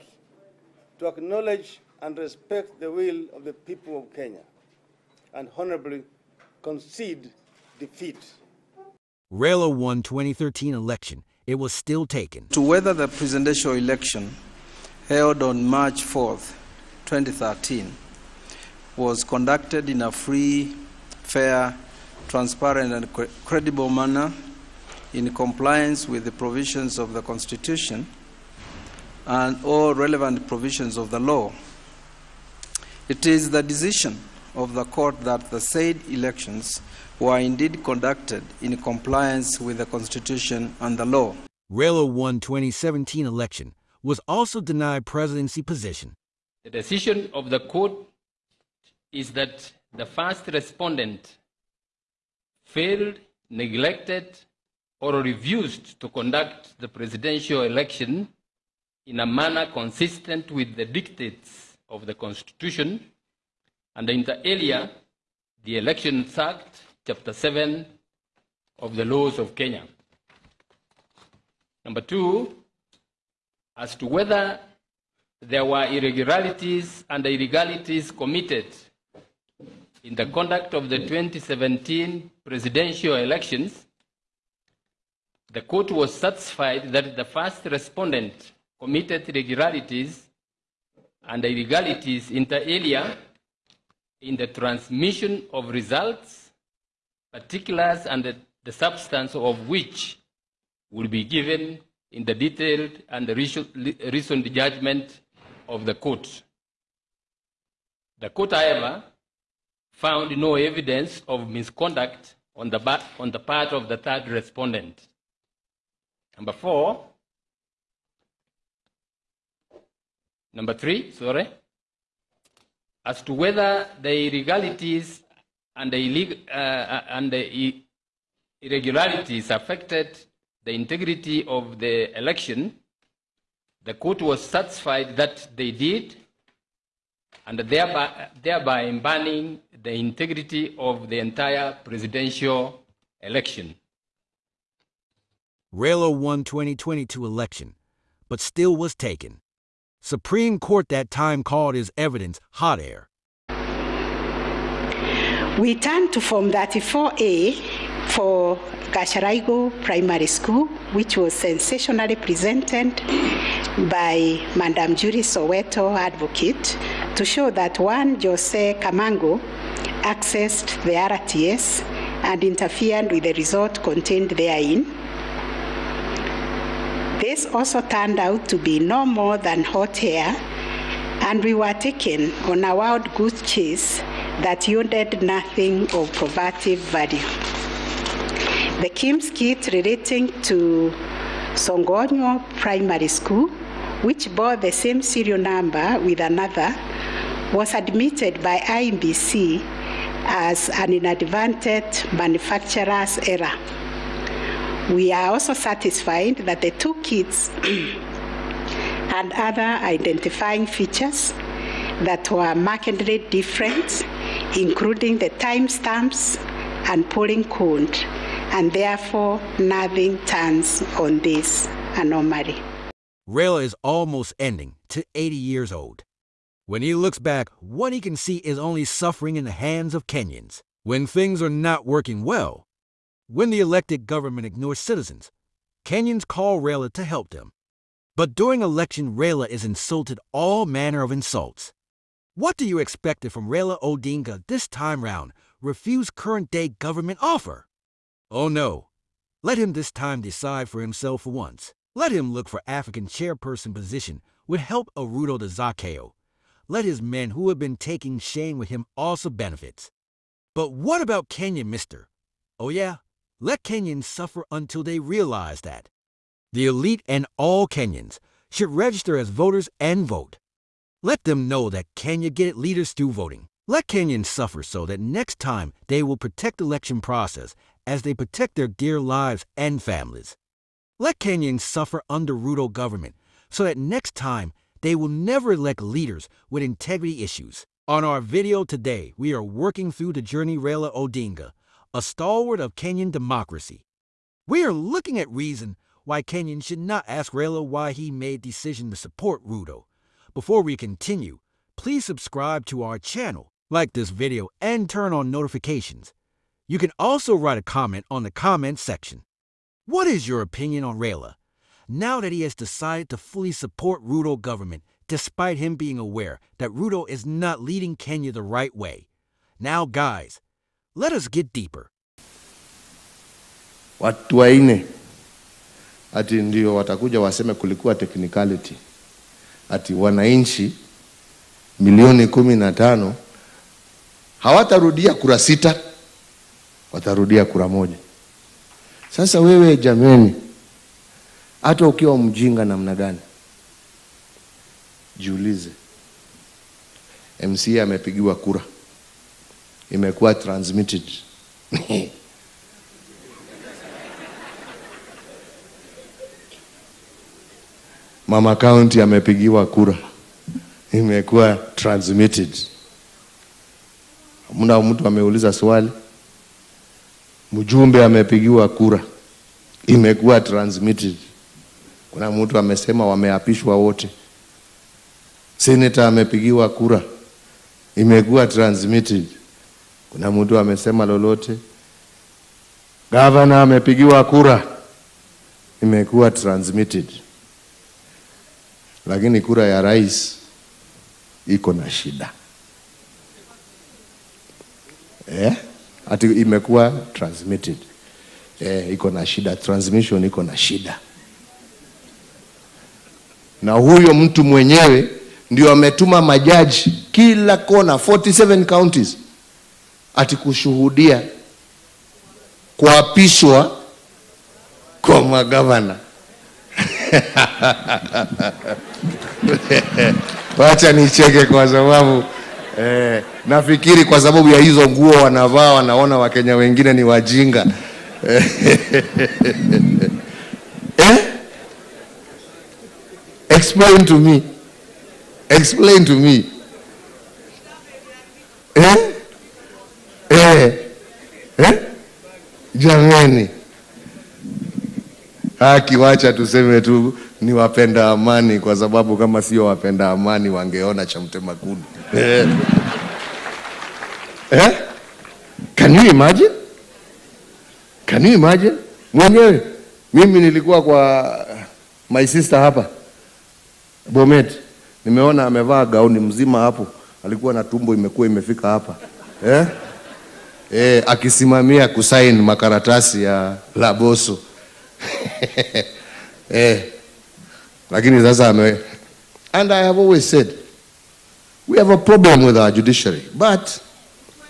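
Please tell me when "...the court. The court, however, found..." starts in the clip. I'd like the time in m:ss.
1:45.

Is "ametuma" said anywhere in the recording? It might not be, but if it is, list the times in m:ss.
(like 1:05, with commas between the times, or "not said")
6:45.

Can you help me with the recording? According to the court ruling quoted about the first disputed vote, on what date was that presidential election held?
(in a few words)
March 4th, 2013.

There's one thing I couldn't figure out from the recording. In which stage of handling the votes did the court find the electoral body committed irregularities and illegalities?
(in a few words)
Transmission of results.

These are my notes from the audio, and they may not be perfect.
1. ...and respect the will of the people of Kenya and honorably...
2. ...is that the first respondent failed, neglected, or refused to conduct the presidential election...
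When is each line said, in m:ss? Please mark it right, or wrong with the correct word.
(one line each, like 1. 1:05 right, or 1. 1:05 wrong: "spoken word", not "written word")
1. 0:02 right
2. 0:49 right.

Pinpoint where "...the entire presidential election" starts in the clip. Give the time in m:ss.
2:21.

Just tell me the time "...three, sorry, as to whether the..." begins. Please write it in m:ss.
2:00.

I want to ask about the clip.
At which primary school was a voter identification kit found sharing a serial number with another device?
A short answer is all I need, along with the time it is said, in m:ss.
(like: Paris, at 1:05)
Songonyo Primary School, at 3:11.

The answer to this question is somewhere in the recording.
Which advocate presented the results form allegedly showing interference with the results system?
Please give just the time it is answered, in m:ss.
2:44.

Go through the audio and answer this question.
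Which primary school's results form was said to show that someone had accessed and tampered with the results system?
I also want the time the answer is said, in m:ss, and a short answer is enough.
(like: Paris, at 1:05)
Gacharaigu Primary School, at 2:38.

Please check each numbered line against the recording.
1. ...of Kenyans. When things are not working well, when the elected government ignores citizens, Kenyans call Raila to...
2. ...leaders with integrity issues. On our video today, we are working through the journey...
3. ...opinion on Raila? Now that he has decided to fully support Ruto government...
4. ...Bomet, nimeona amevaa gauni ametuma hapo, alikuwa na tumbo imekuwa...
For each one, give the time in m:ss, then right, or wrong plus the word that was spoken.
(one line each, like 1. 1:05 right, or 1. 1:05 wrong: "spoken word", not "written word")
1. 3:49 right
2. 4:45 right
3. 5:10 right
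4. 7:44 wrong: "mzima", not "ametuma".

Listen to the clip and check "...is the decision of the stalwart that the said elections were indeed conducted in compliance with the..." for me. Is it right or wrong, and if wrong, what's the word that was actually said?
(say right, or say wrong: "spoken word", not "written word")
wrong: "court", not "stalwart".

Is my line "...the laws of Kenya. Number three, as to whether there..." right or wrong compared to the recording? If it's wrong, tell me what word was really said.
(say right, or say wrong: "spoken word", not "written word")
wrong: "two", not "three".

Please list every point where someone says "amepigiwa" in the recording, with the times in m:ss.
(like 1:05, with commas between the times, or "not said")
5:47, 5:59, 6:08, 6:16, 6:23.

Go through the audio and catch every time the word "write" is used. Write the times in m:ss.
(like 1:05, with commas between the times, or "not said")
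5:07.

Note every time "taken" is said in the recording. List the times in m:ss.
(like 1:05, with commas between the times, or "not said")
0:12, 2:28, 3:01.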